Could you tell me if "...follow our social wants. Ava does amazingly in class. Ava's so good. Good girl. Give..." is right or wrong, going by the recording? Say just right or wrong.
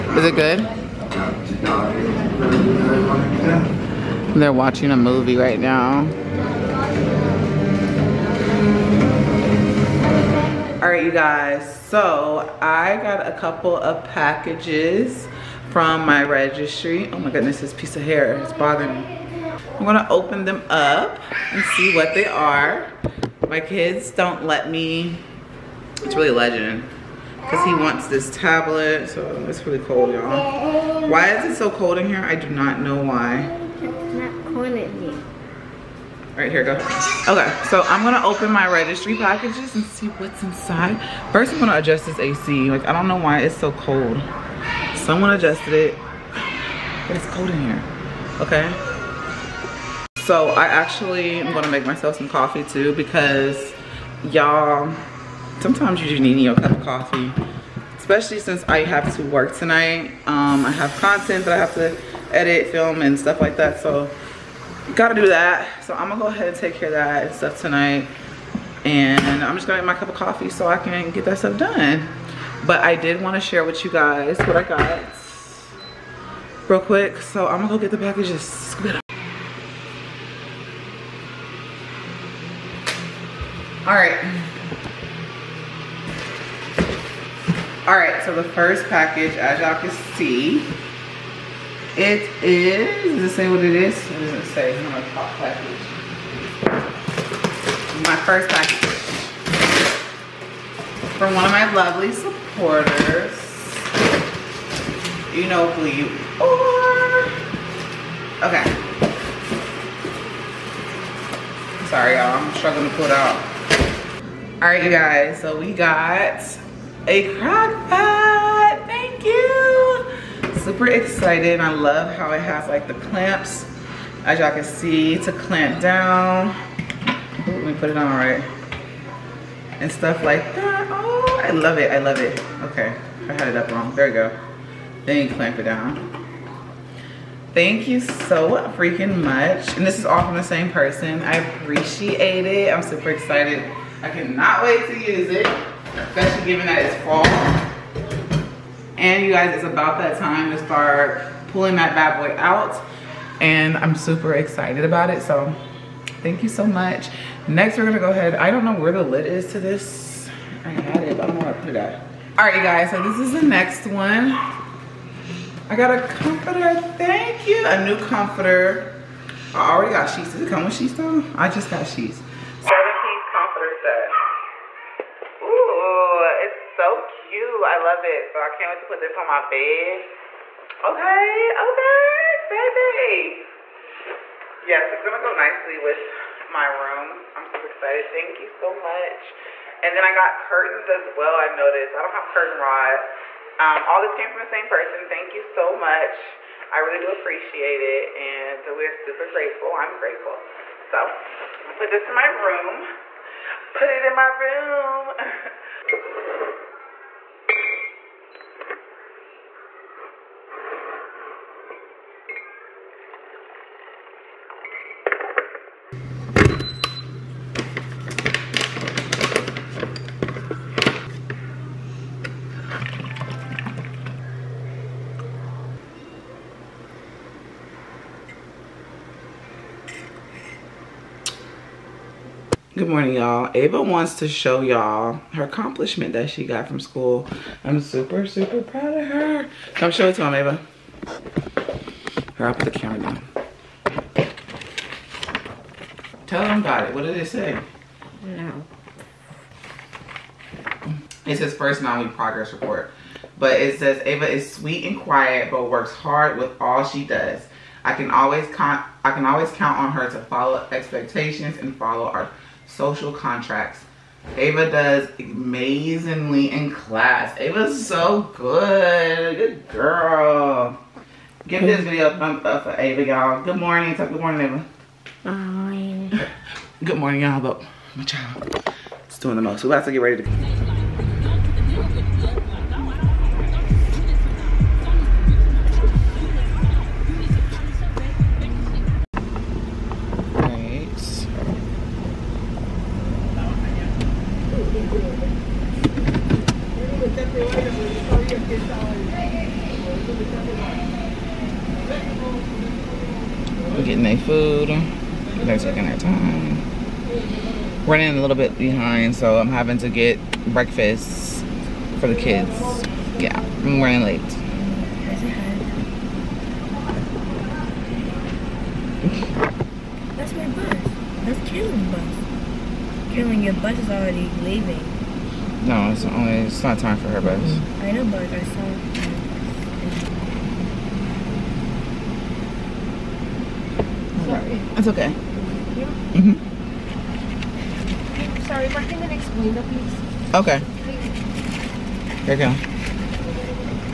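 wrong.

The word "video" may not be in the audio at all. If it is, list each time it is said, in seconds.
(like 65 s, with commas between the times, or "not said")
271 s.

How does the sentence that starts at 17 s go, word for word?
Oh my goodness, this piece of hair is bothering me.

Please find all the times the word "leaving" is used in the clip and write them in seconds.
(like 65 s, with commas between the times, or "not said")
324 s.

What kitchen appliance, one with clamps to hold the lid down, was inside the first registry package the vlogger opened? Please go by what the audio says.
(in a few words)
Crock pot.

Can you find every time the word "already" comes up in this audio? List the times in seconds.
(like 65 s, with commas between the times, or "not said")
169 s, 323 s.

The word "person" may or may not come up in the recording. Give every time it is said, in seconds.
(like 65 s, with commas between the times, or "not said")
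140 s, 194 s.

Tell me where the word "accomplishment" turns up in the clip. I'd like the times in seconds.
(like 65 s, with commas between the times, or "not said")
235 s.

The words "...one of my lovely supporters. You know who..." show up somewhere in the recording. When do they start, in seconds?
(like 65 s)
101 s.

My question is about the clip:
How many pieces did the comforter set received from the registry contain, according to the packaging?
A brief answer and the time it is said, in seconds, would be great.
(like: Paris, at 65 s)
7, at 172 s.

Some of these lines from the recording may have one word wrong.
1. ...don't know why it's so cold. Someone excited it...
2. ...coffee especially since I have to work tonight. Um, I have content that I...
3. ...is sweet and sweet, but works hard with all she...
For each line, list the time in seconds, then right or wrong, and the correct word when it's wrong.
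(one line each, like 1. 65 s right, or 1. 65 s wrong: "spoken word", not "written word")
1. 42 s wrong: "adjusted", not "excited"
2. 56 s right
3. 254 s wrong: "quiet", not "sweet".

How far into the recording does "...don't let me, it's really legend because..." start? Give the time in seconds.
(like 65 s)
24 s.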